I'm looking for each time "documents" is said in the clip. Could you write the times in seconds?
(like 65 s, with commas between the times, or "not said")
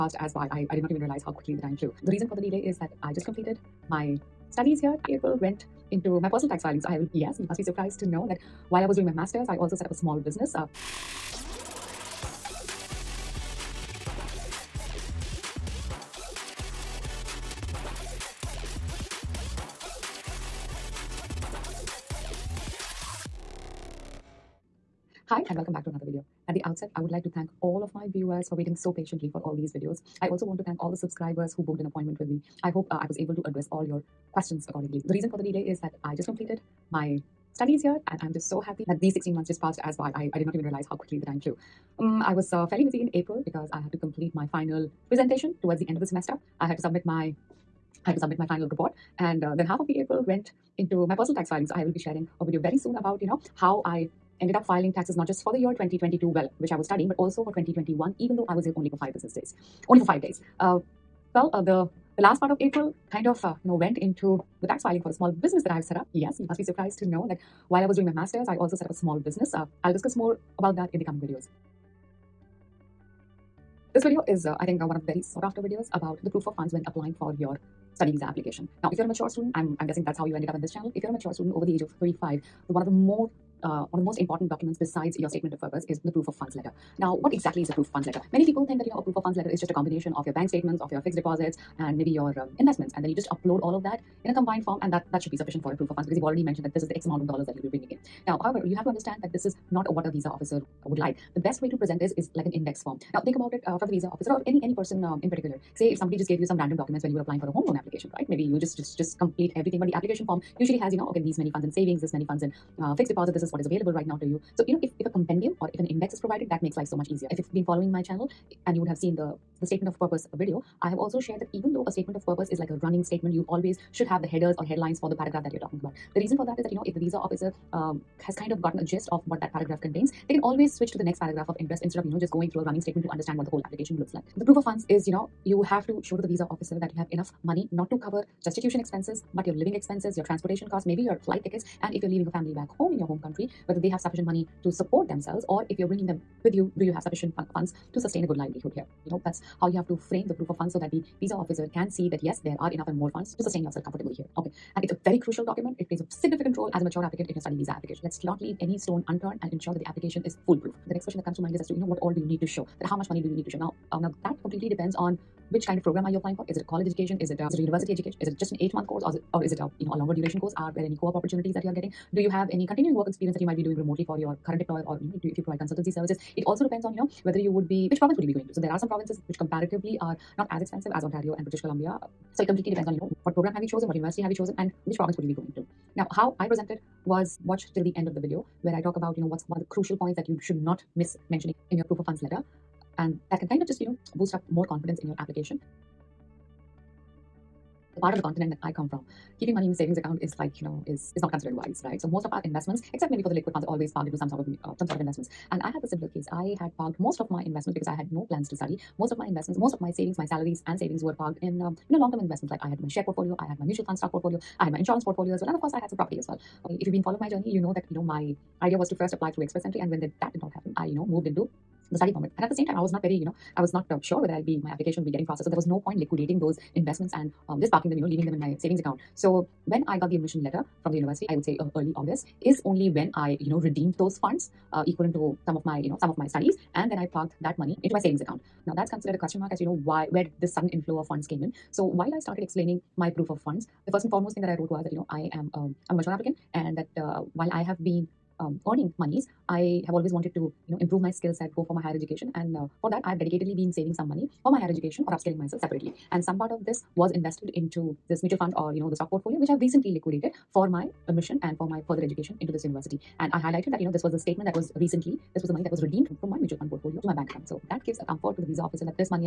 84 s, 106 s, 155 s.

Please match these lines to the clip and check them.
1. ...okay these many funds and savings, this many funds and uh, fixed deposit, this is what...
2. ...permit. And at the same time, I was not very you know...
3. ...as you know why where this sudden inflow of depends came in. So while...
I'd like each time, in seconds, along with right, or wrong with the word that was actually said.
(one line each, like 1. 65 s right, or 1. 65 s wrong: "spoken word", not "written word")
1. 111 s right
2. 222 s right
3. 239 s wrong: "funds", not "depends".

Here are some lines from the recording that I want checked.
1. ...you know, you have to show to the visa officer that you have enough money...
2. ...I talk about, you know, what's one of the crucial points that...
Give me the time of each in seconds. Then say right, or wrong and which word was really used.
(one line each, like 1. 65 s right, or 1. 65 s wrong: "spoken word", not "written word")
1. 135 s right
2. 188 s right.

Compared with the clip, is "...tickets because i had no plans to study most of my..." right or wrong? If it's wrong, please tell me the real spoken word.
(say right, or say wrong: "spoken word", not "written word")
wrong: "investments", not "tickets".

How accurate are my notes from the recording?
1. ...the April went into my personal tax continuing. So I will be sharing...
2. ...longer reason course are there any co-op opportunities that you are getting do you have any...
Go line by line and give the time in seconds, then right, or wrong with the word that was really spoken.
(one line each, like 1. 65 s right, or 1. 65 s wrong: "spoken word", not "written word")
1. 49 s wrong: "filing", not "continuing"
2. 170 s wrong: "duration", not "reason".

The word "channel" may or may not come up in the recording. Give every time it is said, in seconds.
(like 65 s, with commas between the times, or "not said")
80 s, 118 s.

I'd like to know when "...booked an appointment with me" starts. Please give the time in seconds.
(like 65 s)
31 s.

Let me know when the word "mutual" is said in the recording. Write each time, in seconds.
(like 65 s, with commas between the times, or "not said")
213 s, 258 s, 266 s.